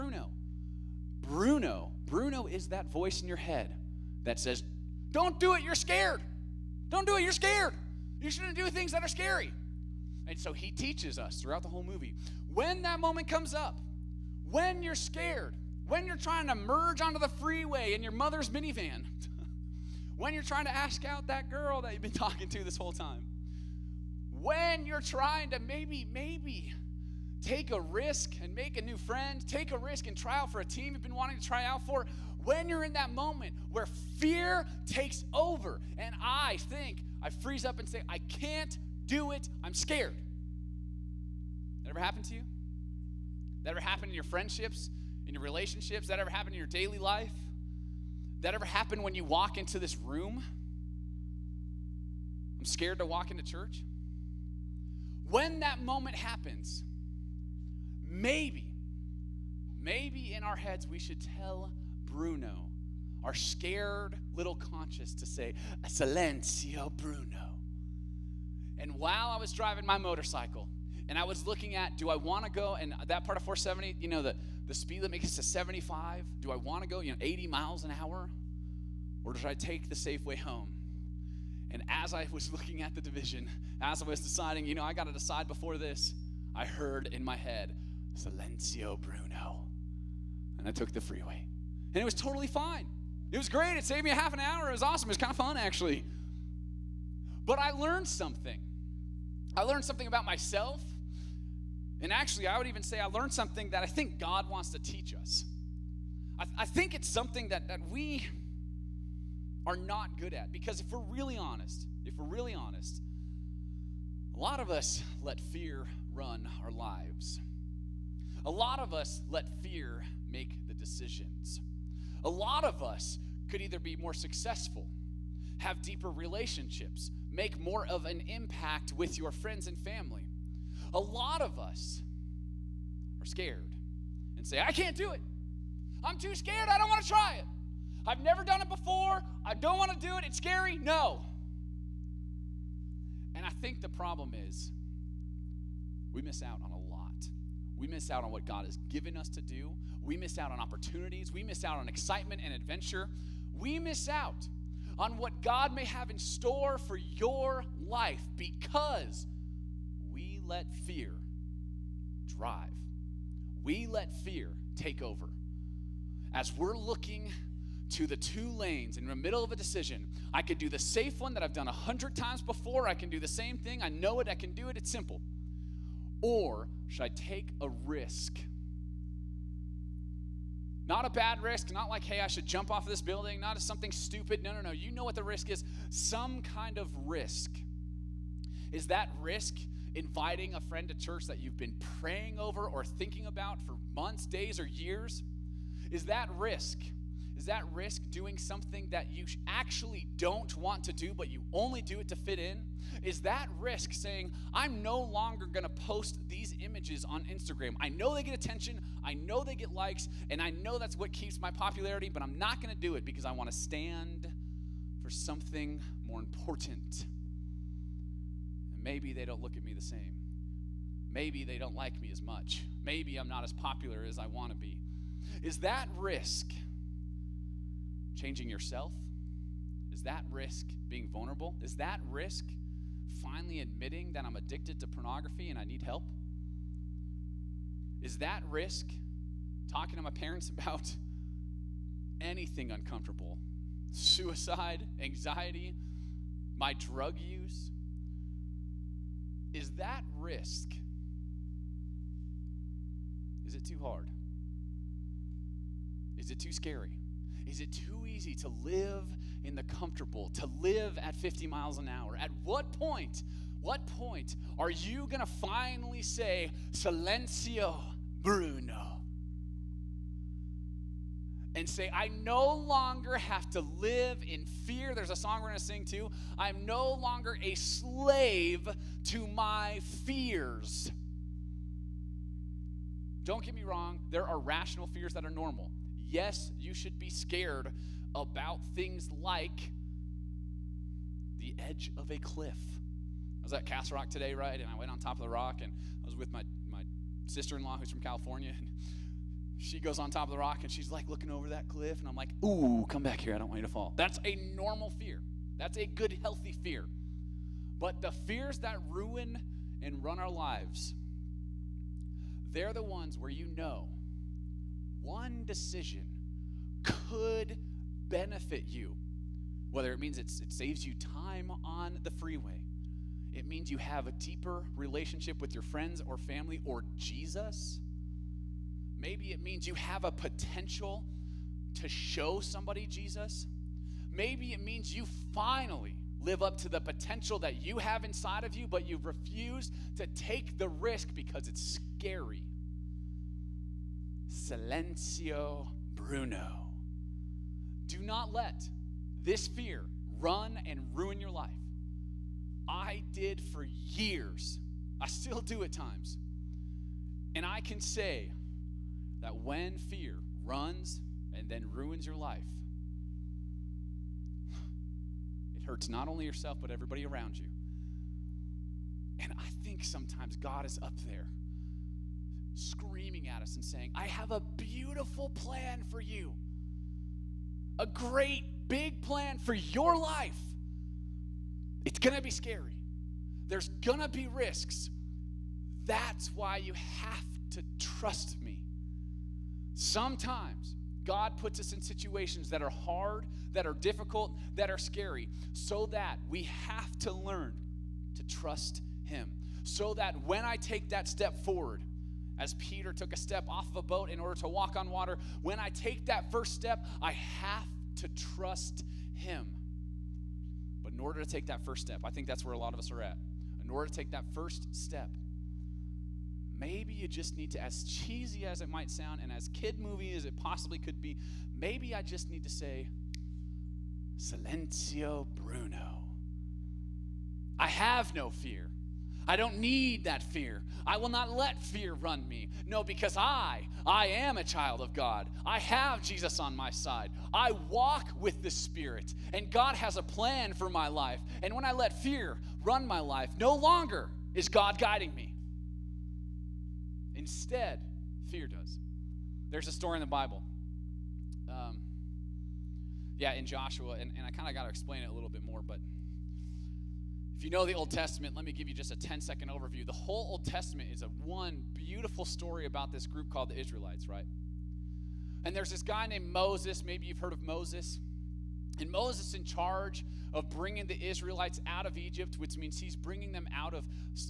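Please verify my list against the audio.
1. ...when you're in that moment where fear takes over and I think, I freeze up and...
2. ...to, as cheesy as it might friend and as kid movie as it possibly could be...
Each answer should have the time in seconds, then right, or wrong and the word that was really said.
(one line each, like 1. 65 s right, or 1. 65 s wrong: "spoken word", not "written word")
1. 32 s right
2. 417 s wrong: "sound", not "friend".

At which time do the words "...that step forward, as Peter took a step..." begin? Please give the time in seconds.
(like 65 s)
400 s.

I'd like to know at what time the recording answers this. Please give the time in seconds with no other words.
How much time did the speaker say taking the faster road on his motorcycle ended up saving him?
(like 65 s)
94 s.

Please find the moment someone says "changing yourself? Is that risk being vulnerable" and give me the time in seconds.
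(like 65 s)
228 s.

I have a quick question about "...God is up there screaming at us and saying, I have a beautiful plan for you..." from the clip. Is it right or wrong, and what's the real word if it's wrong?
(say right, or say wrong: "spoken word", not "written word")
right.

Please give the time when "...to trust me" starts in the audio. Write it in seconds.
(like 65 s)
387 s.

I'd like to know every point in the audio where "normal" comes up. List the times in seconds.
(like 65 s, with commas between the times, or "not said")
285 s, 304 s.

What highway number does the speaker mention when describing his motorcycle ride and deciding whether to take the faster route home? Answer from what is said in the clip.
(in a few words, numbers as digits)
470.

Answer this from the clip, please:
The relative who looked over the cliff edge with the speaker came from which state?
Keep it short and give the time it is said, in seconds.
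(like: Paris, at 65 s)
California, at 297 s.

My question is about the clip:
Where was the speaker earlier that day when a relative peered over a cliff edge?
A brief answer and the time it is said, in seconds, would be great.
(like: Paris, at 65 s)
Castle Rock, at 293 s.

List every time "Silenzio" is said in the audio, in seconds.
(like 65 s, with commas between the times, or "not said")
65 s, 88 s, 266 s, 344 s, 424 s.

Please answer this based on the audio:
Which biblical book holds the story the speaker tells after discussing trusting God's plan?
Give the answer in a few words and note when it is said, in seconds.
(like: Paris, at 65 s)
Joshua, at 453 s.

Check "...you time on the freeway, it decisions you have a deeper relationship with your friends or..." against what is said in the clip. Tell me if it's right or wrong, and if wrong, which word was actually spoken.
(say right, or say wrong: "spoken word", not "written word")
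wrong: "means", not "decisions".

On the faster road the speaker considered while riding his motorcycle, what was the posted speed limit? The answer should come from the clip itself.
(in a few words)
75.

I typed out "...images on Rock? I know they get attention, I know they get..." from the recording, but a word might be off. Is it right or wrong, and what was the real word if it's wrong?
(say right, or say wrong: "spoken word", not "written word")
wrong: "Instagram", not "Rock".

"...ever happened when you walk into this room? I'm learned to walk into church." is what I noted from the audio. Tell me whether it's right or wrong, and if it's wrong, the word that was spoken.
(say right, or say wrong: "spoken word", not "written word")
wrong: "scared", not "learned".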